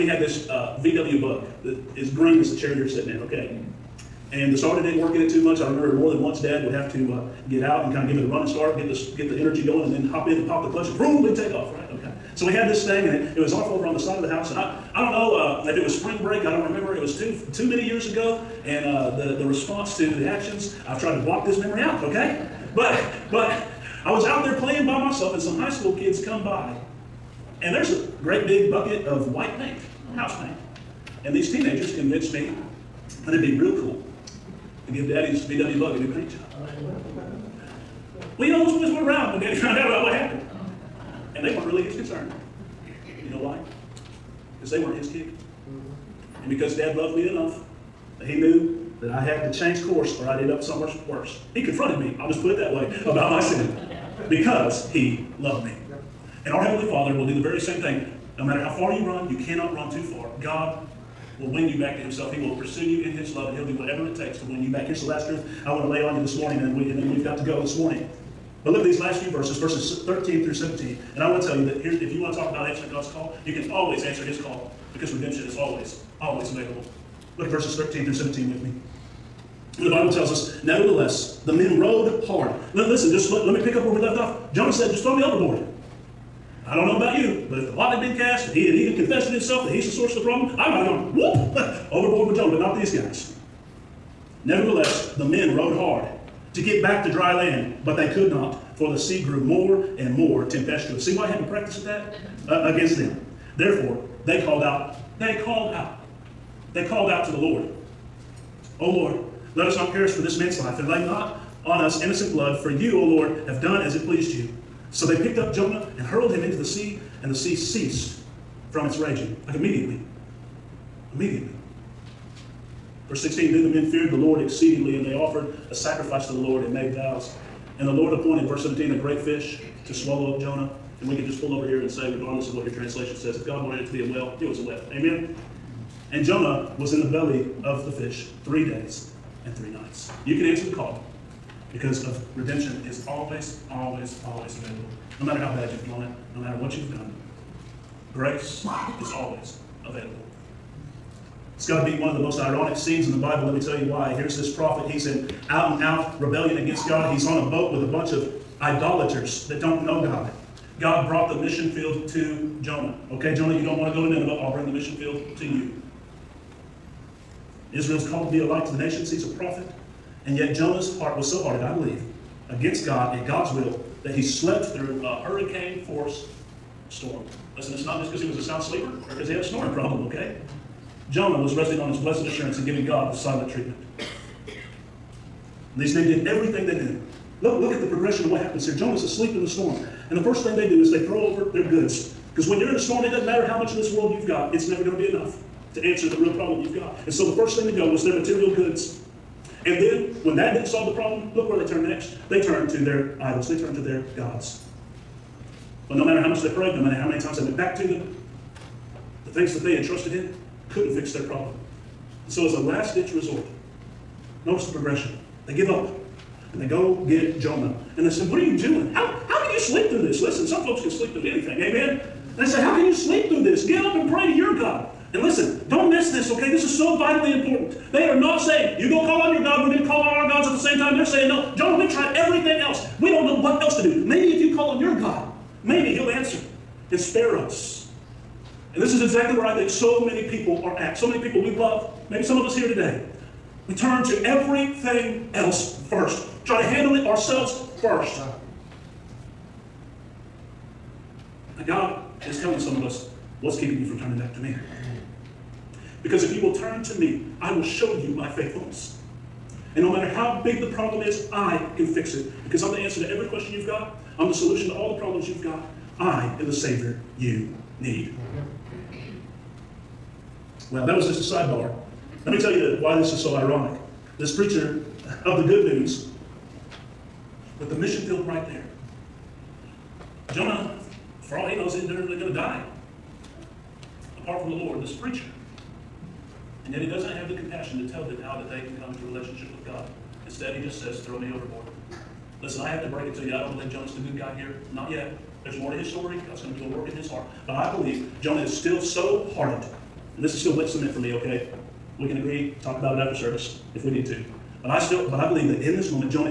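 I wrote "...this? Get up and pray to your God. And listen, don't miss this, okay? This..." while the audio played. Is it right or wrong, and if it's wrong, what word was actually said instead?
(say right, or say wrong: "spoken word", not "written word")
right.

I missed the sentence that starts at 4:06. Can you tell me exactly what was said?
Try to handle it ourselves first.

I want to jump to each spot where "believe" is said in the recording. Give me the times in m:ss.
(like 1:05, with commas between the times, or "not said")
2:51, 4:53, 4:57, 5:05.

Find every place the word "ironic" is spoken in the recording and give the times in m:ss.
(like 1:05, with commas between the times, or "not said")
2:32, 4:33.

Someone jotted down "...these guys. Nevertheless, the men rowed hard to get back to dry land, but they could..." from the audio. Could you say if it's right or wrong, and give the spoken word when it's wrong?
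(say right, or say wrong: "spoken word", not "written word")
right.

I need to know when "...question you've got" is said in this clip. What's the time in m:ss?
4:23.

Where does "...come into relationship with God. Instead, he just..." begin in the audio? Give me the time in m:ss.
4:48.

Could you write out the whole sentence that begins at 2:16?
And Jonah was in the belly of the fish three days and three nights.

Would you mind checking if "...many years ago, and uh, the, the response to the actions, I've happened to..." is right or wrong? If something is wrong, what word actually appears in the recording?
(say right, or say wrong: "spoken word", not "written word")
wrong: "tried", not "happened".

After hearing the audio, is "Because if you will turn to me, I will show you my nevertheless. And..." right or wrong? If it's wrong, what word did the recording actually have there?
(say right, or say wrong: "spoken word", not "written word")
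wrong: "faithfulness", not "nevertheless".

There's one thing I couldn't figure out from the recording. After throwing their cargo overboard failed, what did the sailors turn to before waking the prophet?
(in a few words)
Their idols.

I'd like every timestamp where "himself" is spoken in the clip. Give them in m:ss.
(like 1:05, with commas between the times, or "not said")
1:01, 1:29.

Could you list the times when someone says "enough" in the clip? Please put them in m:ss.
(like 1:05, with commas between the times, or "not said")
0:47, 3:15.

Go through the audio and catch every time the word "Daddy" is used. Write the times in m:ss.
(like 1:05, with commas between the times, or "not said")
0:35, 0:39.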